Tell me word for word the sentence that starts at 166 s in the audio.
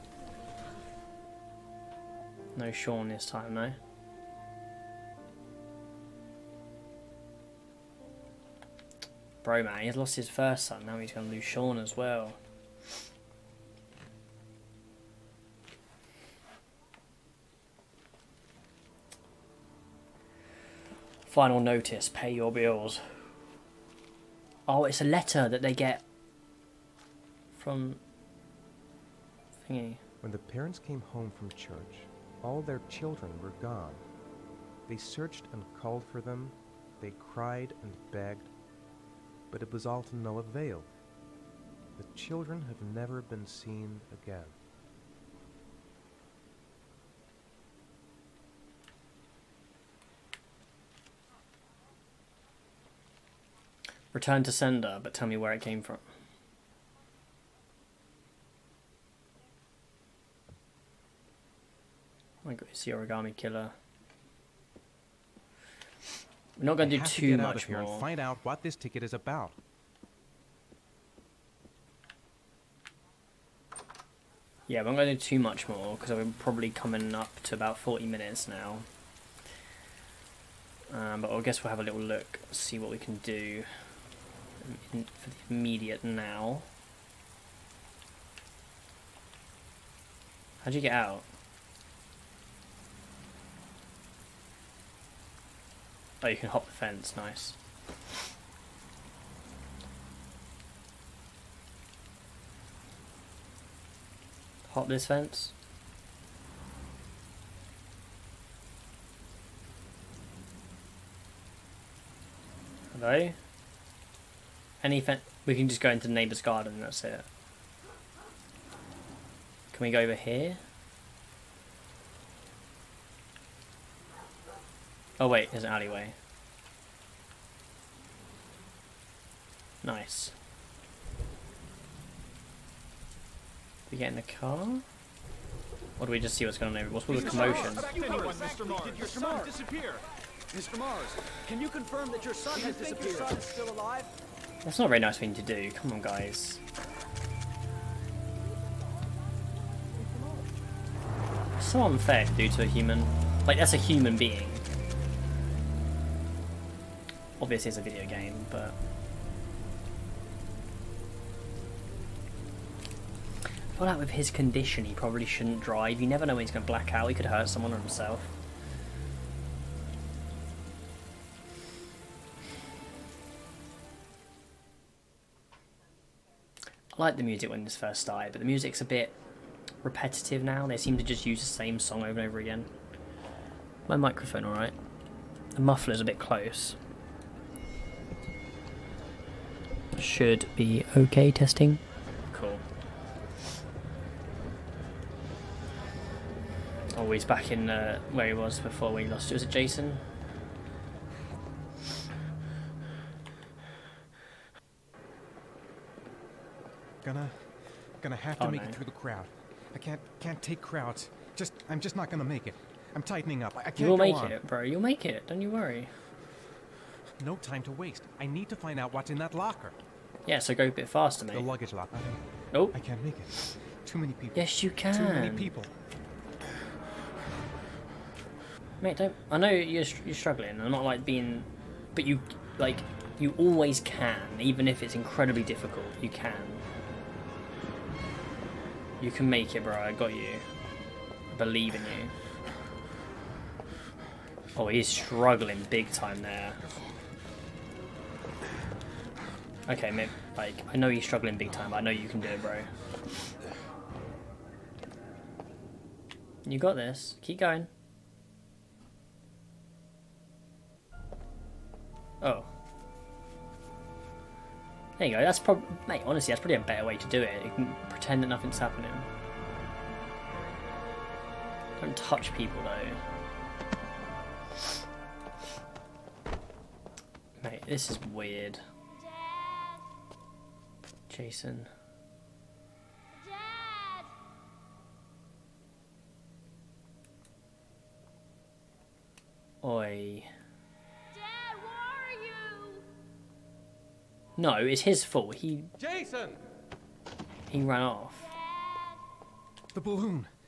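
You never know when he's going to black out.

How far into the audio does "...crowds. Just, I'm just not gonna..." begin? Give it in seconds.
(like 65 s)
210 s.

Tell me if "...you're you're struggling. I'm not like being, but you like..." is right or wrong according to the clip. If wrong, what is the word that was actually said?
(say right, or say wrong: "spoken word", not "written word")
right.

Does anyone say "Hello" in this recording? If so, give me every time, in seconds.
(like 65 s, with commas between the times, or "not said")
112 s.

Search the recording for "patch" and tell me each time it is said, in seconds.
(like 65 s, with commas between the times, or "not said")
not said.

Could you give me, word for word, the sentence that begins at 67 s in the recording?
And find out what this ticket is about.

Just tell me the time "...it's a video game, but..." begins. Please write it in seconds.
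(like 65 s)
157 s.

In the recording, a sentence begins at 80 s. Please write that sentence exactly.
Um, but I guess we'll have a little look, see what we can do in, for the immediate now.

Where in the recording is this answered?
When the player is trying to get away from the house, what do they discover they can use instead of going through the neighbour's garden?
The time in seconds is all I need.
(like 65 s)
125 s.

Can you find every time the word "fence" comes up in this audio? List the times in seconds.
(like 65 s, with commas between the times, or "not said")
96 s, 105 s, 115 s.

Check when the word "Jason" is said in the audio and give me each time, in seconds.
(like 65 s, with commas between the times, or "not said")
199 s, 281 s, 295 s.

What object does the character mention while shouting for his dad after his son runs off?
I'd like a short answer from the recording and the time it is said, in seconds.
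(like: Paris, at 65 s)
The balloon, at 299 s.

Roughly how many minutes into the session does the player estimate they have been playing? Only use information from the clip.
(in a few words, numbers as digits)
40.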